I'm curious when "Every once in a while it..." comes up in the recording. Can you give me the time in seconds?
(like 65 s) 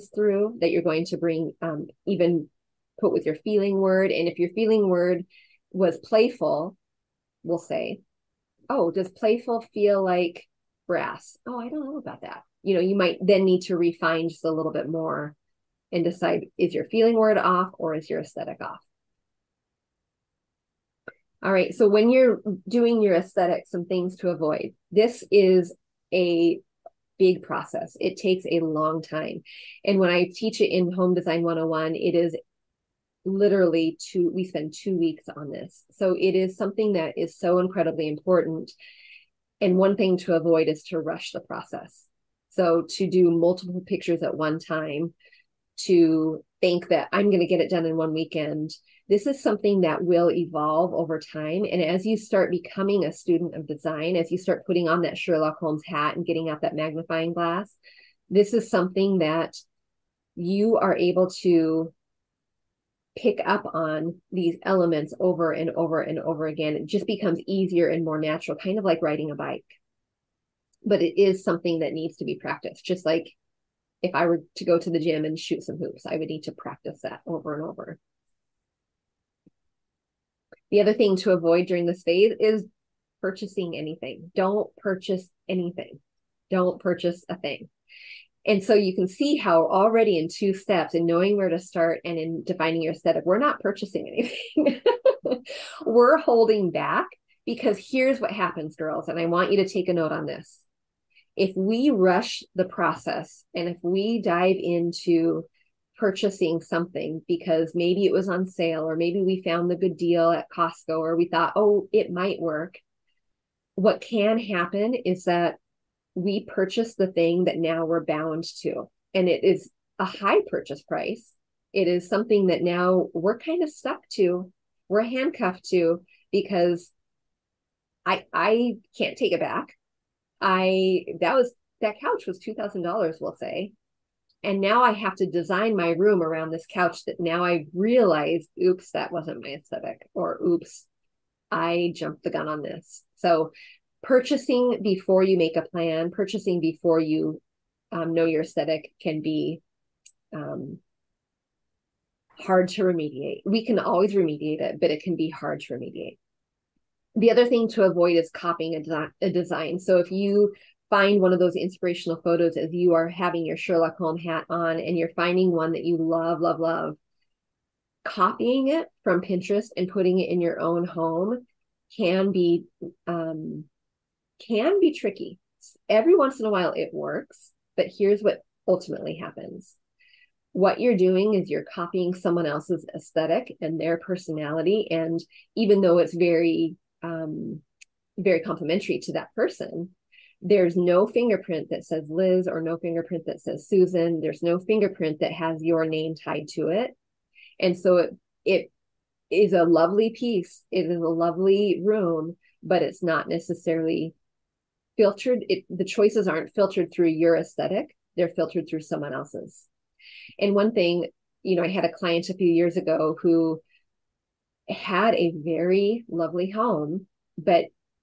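175 s.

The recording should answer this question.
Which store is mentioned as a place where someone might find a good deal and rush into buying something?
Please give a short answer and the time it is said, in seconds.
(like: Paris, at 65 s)
Costco, at 110 s.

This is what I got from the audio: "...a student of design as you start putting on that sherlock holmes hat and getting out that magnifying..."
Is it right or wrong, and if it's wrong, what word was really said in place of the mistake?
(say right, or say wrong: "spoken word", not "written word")
right.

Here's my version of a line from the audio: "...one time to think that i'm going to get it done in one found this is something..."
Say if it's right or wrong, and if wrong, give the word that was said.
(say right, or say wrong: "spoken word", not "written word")
wrong: "weekend", not "found".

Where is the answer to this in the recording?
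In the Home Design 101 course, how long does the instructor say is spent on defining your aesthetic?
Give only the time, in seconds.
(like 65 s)
34 s.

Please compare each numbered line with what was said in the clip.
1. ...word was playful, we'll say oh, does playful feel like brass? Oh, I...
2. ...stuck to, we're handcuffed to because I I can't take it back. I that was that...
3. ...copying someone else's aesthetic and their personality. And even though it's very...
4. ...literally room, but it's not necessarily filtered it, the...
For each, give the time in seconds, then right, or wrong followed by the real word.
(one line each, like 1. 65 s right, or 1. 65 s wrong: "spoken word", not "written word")
1. 4 s right
2. 123 s right
3. 181 s right
4. 201 s wrong: "lovely", not "literally".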